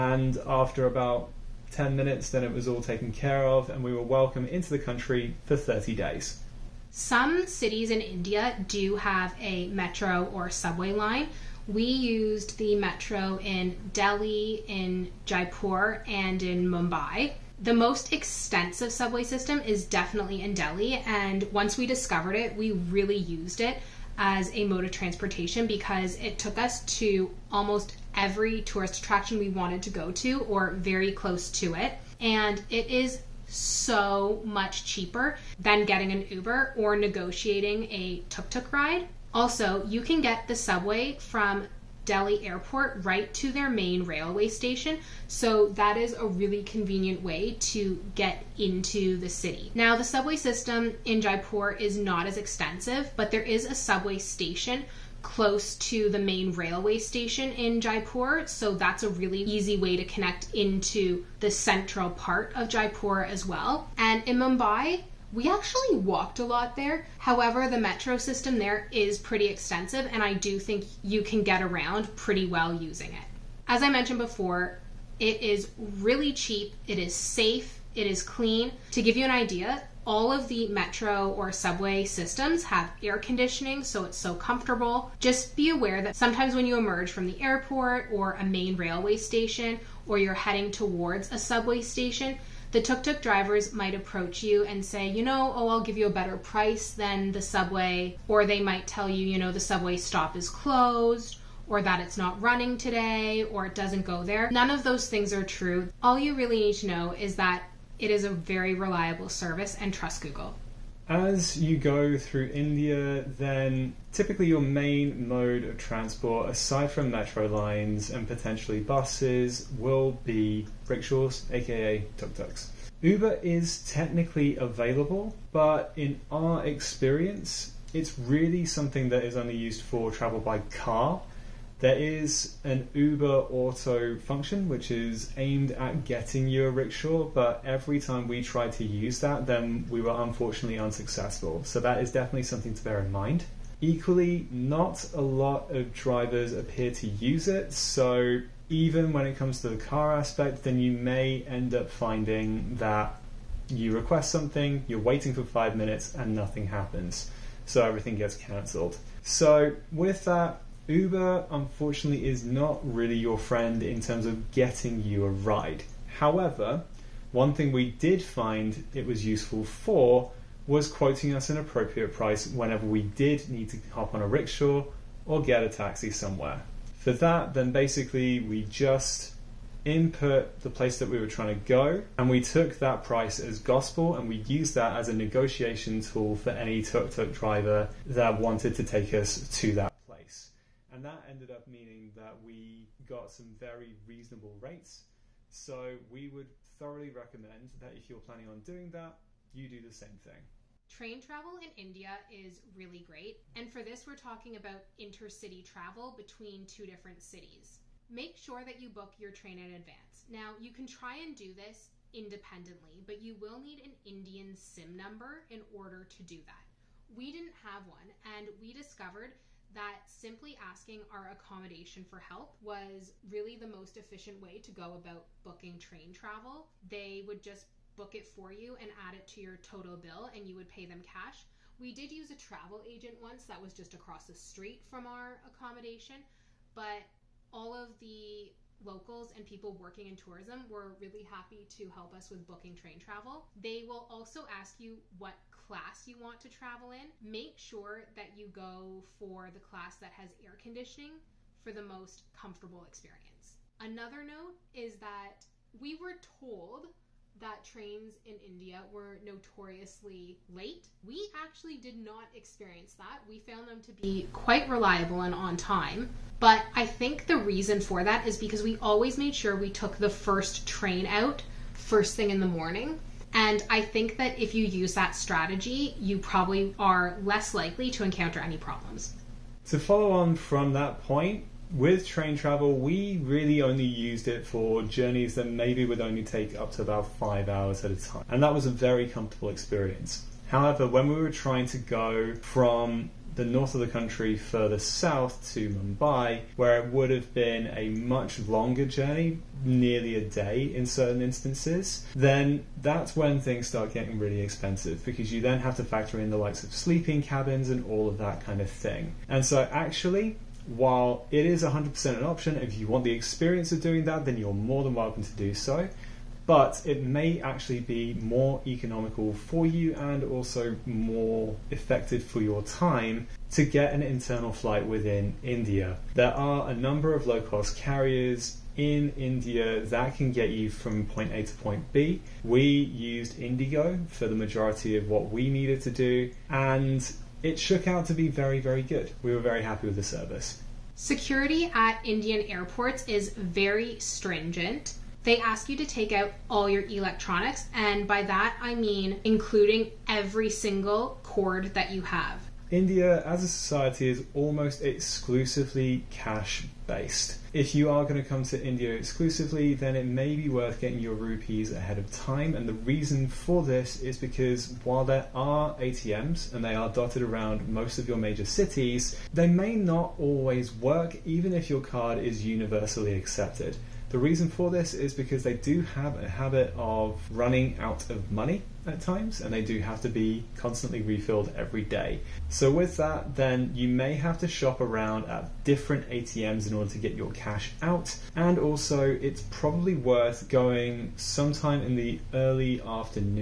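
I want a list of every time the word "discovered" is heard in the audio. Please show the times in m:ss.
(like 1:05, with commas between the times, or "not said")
0:21, 3:38.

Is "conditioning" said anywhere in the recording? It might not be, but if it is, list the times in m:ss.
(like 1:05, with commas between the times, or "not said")
1:23, 4:10.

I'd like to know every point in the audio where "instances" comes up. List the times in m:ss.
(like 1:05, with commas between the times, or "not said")
5:01.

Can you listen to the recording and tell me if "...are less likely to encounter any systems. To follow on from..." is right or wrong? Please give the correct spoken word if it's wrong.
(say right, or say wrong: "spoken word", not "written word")
wrong: "problems", not "systems".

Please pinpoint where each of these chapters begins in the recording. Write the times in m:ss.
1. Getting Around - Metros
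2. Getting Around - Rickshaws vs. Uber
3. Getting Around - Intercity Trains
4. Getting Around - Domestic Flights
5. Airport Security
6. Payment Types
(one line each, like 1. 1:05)
1. 0:06
2. 1:50
3. 3:20
4. 4:38
5. 5:40
6. 5:52.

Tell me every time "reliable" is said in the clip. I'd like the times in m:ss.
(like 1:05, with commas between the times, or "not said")
1:48, 4:24.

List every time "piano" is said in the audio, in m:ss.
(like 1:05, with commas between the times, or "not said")
not said.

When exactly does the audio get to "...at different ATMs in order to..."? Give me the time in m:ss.
6:25.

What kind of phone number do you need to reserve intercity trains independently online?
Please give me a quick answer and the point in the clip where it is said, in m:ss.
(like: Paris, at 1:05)
Indian SIM number, at 3:34.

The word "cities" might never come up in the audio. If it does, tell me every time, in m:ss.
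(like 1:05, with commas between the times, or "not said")
0:07, 3:27, 6:08.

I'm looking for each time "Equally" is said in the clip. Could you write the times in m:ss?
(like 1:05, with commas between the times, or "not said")
2:23.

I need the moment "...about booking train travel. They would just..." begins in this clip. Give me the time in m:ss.
3:44.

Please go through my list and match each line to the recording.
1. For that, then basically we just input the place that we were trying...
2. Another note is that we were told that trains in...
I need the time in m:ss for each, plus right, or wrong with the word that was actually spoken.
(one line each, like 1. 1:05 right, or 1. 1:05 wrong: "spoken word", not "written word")
1. 2:57 right
2. 4:13 right.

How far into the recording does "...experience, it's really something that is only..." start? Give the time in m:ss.
2:06.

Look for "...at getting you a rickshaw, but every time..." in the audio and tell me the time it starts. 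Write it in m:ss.
2:15.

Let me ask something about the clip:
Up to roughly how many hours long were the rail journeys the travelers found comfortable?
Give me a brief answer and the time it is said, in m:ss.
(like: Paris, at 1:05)
5 hours, at 4:47.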